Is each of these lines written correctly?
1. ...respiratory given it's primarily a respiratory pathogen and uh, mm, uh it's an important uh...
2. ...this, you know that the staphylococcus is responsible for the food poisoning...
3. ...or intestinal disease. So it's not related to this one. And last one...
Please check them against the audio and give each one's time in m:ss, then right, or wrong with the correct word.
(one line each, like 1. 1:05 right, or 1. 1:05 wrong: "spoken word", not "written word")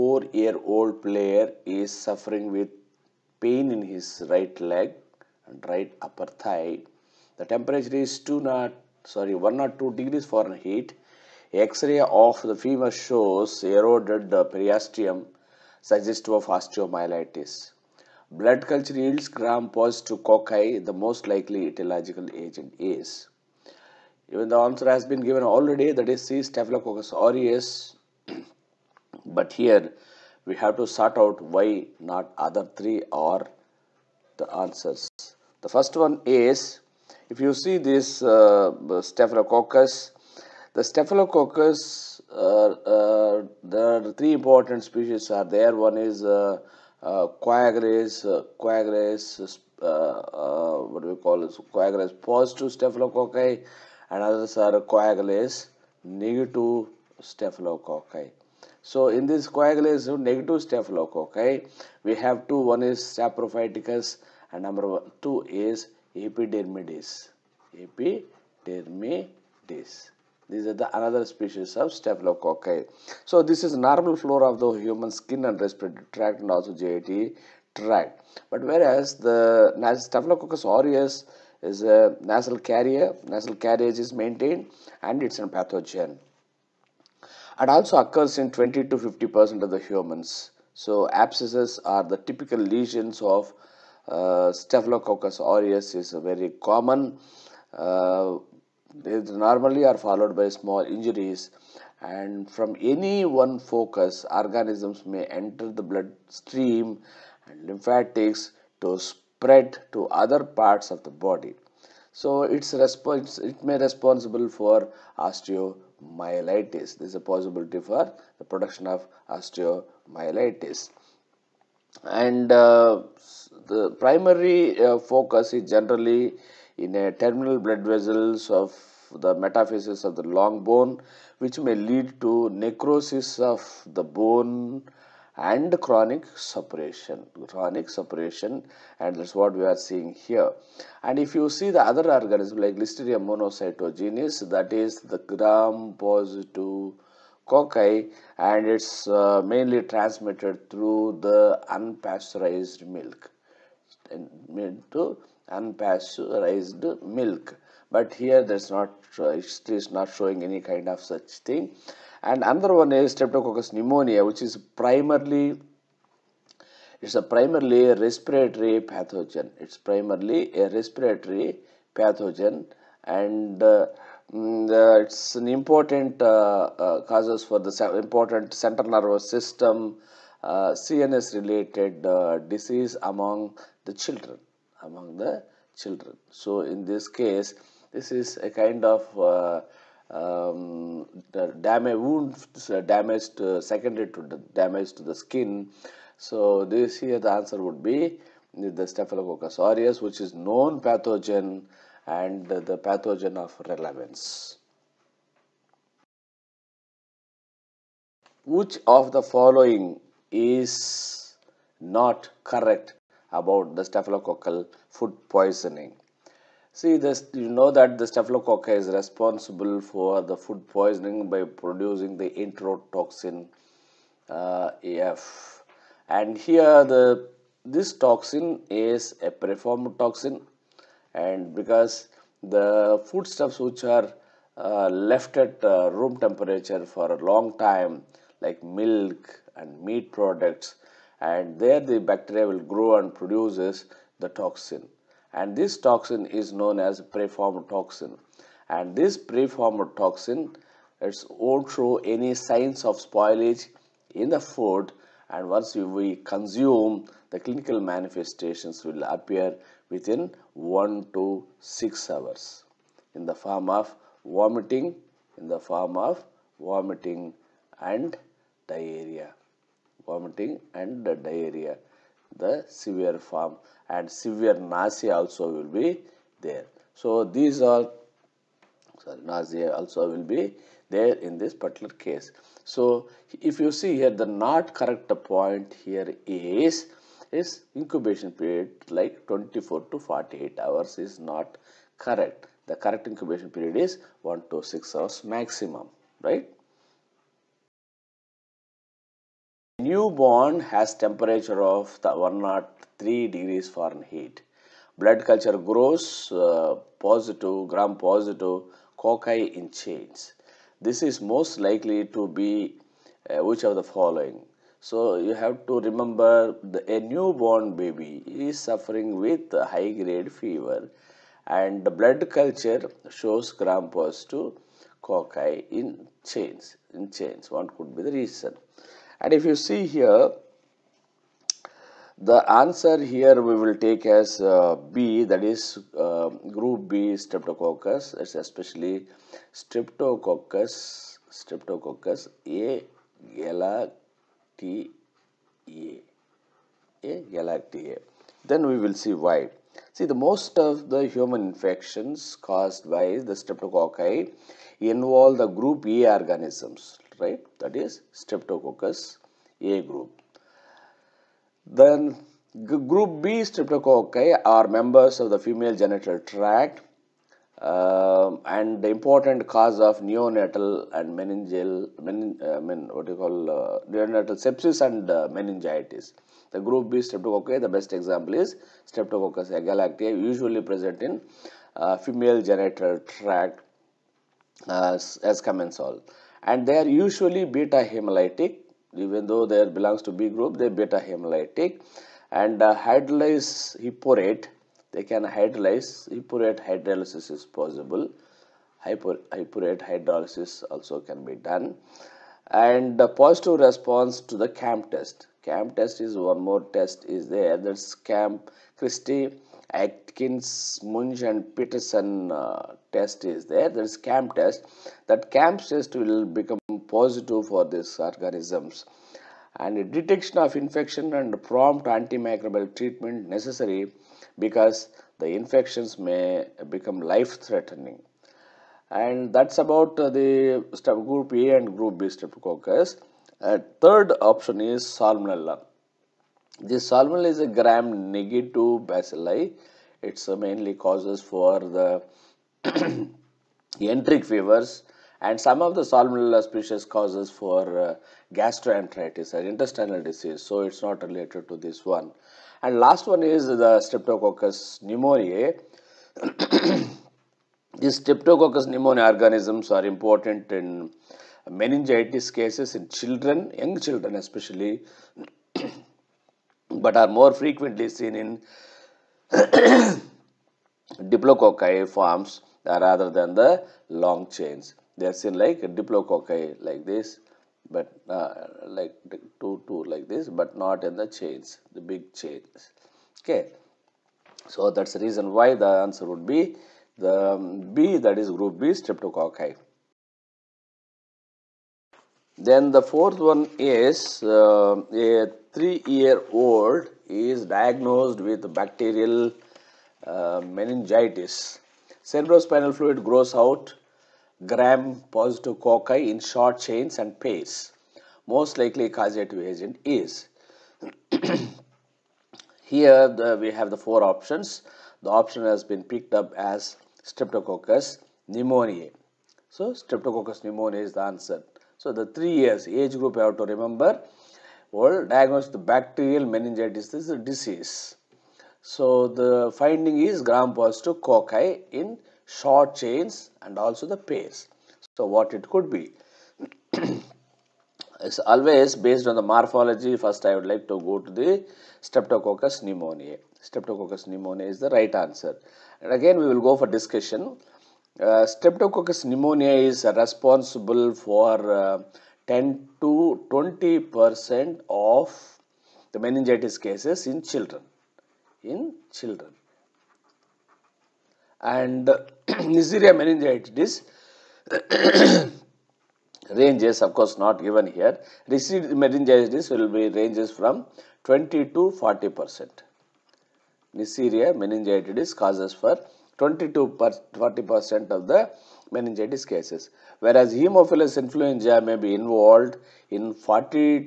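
1. 2:48 wrong: "pathogen", not "given"
2. 3:36 right
3. 7:29 right.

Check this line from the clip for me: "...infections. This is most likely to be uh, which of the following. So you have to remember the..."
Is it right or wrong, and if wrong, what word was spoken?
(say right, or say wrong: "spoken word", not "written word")
wrong: "chains", not "infections".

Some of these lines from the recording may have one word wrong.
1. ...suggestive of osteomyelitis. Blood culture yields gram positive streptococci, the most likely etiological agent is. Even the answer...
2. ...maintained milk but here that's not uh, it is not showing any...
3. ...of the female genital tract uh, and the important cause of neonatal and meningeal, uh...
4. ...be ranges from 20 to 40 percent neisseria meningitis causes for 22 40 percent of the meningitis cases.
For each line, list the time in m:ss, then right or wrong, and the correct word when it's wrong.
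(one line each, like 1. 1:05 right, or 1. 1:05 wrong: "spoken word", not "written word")
1. 0:15 wrong: "cocci", not "streptococci"
2. 2:35 wrong: "unpasteurized", not "maintained"
3. 6:05 right
4. 9:29 right.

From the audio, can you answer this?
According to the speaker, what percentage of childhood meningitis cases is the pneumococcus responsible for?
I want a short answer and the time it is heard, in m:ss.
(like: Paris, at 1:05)
10 to 20 percent, at 9:12.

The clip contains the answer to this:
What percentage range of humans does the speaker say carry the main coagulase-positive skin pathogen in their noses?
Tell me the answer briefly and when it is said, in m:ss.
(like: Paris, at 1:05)
20 to 50 percent, at 1:28.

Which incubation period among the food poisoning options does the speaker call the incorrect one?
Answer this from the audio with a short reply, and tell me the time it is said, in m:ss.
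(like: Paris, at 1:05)
24 to 48 hours, at 4:49.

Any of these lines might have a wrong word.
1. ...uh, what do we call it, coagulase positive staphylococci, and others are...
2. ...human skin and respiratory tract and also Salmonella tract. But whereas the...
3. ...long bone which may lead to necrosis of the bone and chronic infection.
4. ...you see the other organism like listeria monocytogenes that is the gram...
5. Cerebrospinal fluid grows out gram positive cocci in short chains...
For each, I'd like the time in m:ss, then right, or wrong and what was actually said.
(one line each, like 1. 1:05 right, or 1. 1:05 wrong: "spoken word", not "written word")
1. 0:49 right
2. 1:14 wrong: "GIT", not "Salmonella"
3. 2:10 wrong: "suppuration", not "infection"
4. 2:21 right
5. 8:22 right.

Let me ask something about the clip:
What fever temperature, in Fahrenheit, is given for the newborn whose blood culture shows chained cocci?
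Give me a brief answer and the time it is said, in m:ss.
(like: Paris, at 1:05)
103 degrees, at 5:02.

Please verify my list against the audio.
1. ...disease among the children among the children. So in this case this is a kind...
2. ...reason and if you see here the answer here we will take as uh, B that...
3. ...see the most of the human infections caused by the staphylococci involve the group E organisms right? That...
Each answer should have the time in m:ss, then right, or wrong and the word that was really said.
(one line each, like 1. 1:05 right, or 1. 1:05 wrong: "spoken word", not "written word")
1. 3:02 right
2. 5:28 right
3. 5:49 wrong: "streptococci", not "staphylococci".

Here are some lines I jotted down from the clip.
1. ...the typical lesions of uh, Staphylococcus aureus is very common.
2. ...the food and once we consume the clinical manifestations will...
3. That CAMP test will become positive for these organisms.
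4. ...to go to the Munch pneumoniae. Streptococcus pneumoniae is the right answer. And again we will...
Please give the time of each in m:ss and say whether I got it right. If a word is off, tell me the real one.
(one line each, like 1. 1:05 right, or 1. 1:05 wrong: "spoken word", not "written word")
1. 1:32 right
2. 4:14 right
3. 6:55 right
4. 9:00 wrong: "Streptococcus", not "Munch".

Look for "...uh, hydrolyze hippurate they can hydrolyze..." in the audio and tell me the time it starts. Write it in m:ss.
6:32.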